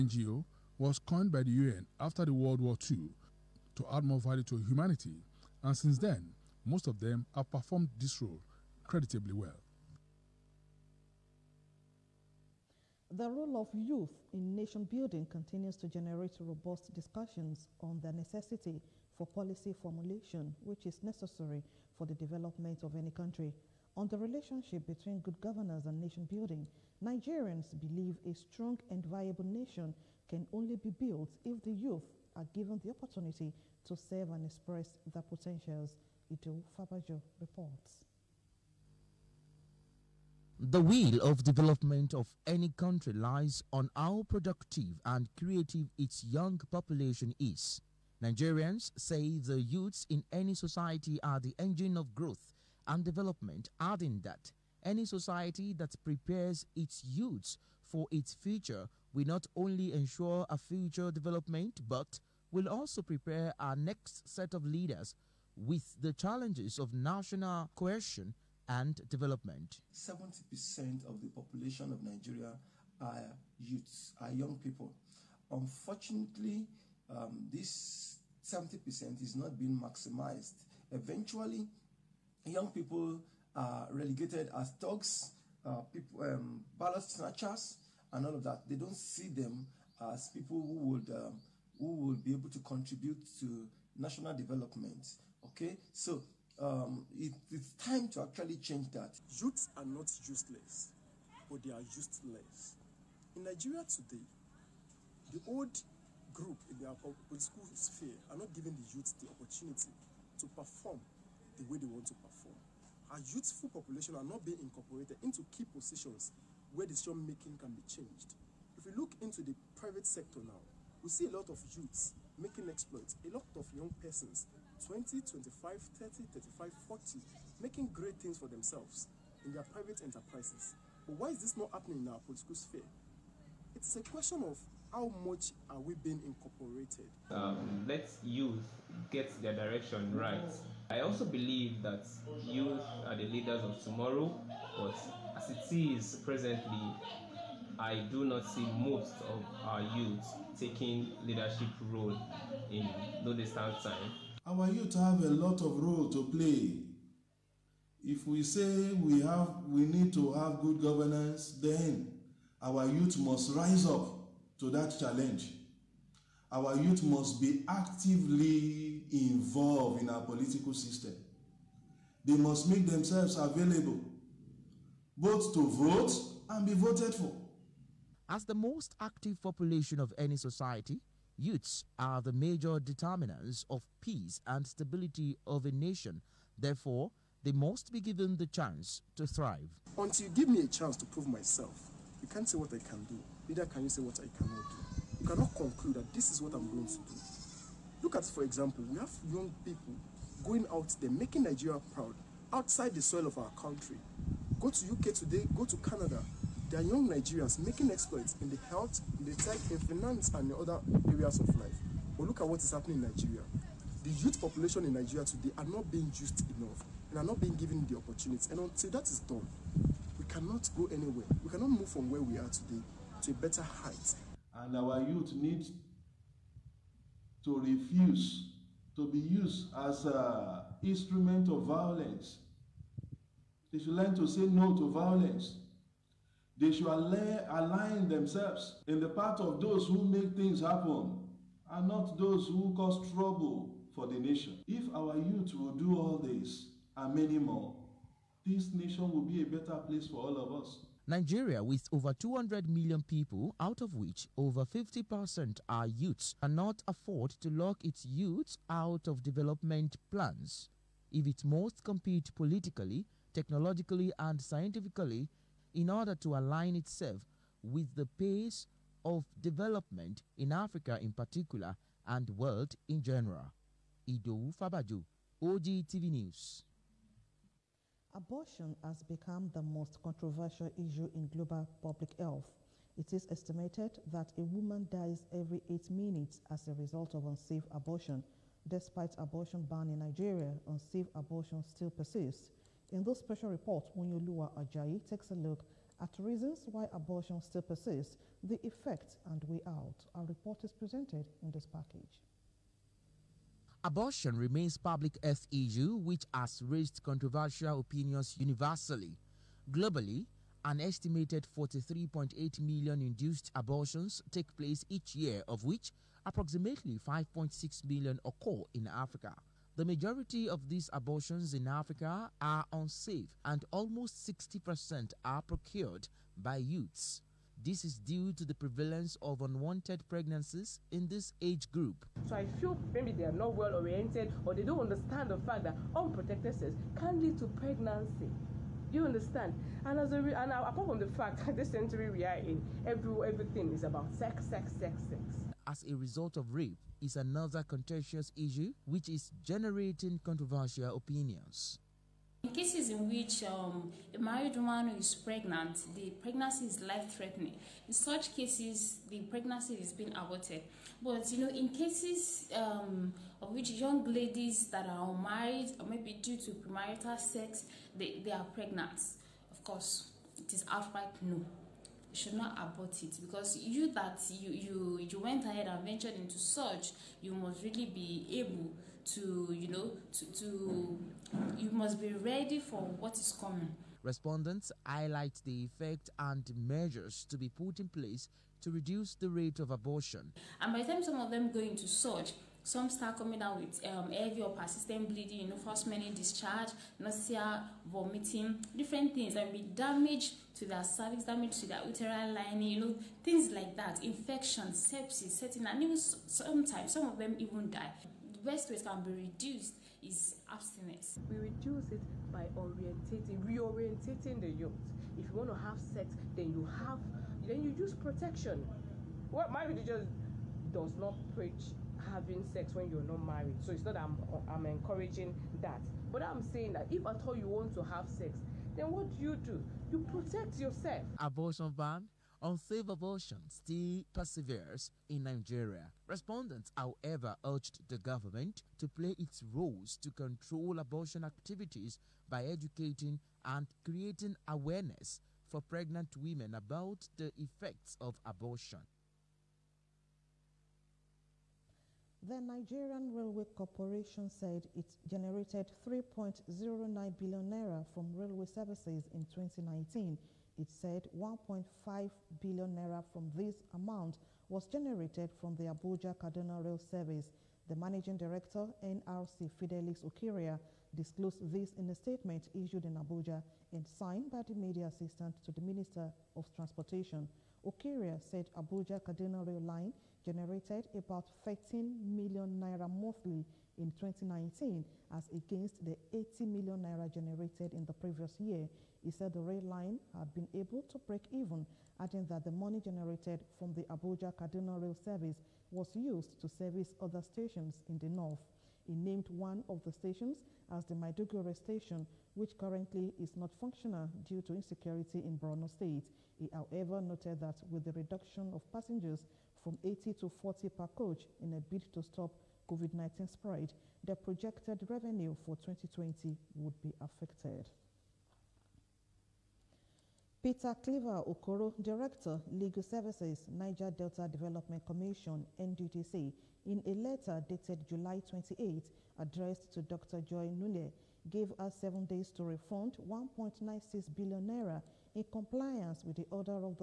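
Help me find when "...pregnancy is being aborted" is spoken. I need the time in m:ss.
5:59.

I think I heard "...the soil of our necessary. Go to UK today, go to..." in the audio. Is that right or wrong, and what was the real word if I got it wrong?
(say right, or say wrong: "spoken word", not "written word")
wrong: "country", not "necessary".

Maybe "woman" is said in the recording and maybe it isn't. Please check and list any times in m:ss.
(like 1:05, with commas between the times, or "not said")
4:44, 5:54.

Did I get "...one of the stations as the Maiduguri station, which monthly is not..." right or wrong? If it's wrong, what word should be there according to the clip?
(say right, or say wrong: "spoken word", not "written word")
wrong: "currently", not "monthly".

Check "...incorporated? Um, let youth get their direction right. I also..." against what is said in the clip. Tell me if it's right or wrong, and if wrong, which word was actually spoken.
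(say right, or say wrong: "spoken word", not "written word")
right.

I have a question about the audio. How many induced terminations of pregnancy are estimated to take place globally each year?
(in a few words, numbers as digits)
43.8 million.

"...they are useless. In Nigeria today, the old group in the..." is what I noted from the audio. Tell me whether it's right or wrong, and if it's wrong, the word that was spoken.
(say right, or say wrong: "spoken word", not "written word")
right.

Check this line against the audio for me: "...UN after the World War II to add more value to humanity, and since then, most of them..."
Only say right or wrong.
right.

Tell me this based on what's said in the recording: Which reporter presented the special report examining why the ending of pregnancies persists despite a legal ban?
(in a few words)
Onyolua Ajayi.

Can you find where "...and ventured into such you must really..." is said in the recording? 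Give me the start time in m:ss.
6:15.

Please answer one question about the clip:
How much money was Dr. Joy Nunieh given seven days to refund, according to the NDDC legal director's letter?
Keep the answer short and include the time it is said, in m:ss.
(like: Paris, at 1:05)
1.96 billion naira, at 8:53.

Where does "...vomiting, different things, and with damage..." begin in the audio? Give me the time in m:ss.
6:37.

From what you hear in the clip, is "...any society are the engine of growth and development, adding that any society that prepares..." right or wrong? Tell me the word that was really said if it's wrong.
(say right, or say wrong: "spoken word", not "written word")
right.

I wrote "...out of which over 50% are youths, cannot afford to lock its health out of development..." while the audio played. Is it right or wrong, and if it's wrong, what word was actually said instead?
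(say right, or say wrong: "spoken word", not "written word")
wrong: "youth", not "health".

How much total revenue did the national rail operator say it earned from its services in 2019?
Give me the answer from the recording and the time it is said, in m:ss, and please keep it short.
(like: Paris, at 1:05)
3.09 billion naira, at 7:35.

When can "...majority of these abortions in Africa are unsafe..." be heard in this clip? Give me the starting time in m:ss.
5:19.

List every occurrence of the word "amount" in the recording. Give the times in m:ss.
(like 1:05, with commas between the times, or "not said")
7:43.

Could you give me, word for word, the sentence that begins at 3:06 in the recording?
Therefore, they must be given the chance to thrive.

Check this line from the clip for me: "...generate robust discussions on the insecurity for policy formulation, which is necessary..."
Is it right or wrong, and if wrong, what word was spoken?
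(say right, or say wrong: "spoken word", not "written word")
wrong: "necessity", not "insecurity".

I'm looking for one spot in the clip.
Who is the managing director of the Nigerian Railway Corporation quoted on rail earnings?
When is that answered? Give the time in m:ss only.
7:49.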